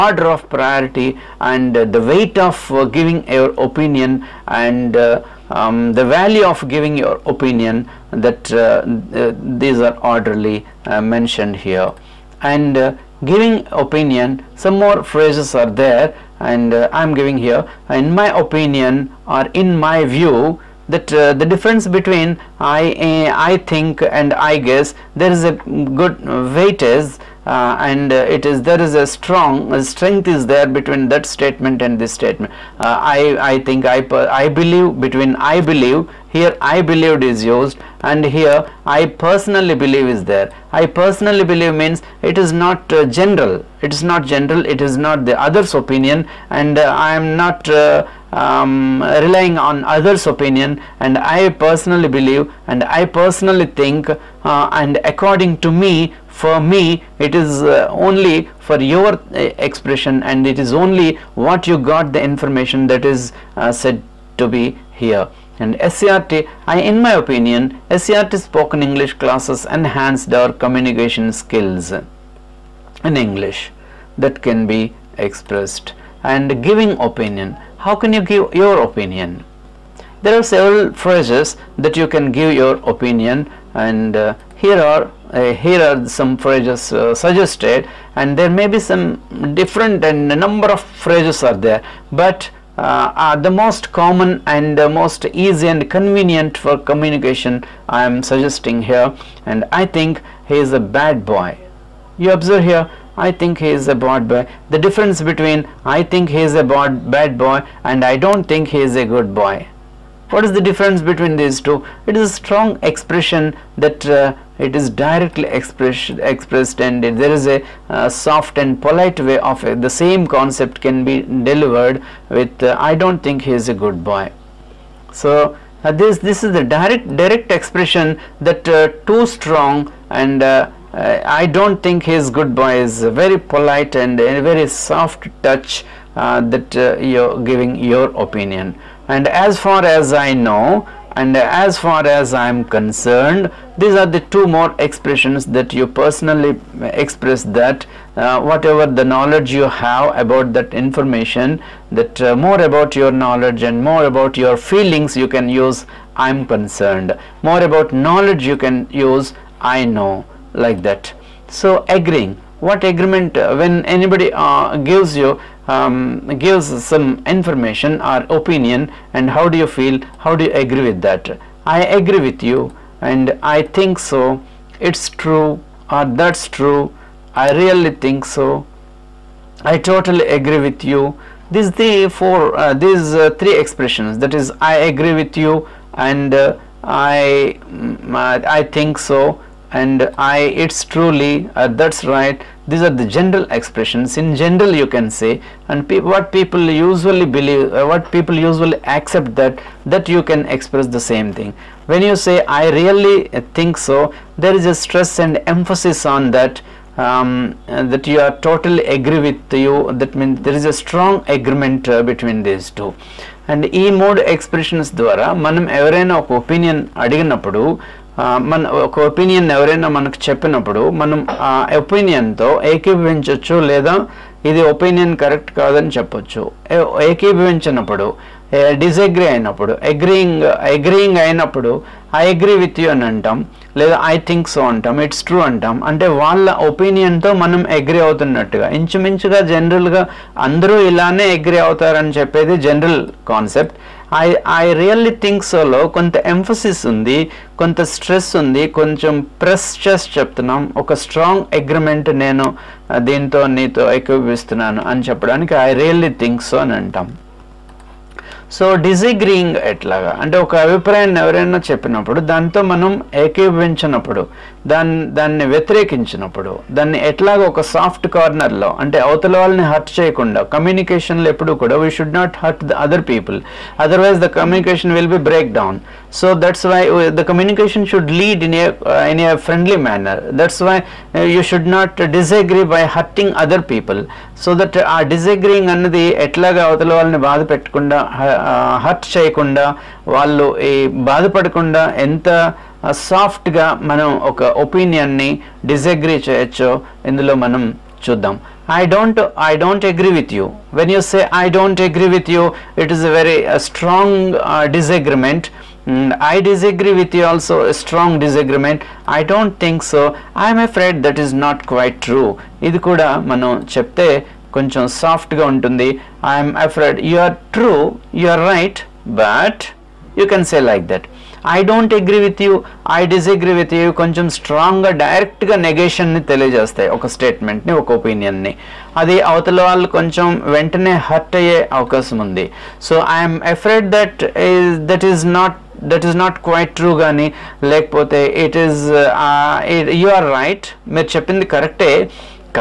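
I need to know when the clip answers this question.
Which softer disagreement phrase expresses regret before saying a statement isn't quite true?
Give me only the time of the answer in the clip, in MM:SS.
05:10.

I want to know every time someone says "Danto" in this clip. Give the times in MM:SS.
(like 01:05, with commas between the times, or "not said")
04:22.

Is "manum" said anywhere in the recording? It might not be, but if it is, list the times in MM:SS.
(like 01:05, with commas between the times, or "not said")
04:22.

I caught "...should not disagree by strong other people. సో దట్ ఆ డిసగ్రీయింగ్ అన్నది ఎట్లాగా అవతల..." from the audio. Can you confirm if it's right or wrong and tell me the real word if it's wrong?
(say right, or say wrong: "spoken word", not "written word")
wrong: "hurting", not "strong".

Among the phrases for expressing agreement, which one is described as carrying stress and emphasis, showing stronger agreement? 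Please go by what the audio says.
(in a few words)
I really think so.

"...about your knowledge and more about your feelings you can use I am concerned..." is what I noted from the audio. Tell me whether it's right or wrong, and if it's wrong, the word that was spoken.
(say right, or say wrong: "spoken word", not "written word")
right.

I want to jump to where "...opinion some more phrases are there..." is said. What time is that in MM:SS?
00:13.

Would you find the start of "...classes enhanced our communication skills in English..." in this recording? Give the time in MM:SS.
01:09.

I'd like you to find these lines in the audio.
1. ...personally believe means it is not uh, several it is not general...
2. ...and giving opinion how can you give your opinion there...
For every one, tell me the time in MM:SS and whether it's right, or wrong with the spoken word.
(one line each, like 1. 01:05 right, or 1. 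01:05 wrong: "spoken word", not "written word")
1. 00:40 wrong: "general", not "several"
2. 01:16 right.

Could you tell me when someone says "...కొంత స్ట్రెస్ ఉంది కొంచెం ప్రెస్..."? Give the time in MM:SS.
04:07.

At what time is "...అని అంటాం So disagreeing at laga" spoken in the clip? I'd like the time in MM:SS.
04:16.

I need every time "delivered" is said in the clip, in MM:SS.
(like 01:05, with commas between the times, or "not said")
02:01.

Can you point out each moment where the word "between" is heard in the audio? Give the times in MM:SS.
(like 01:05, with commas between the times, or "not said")
00:21, 00:30, 00:34, 01:45, 01:51, 03:32.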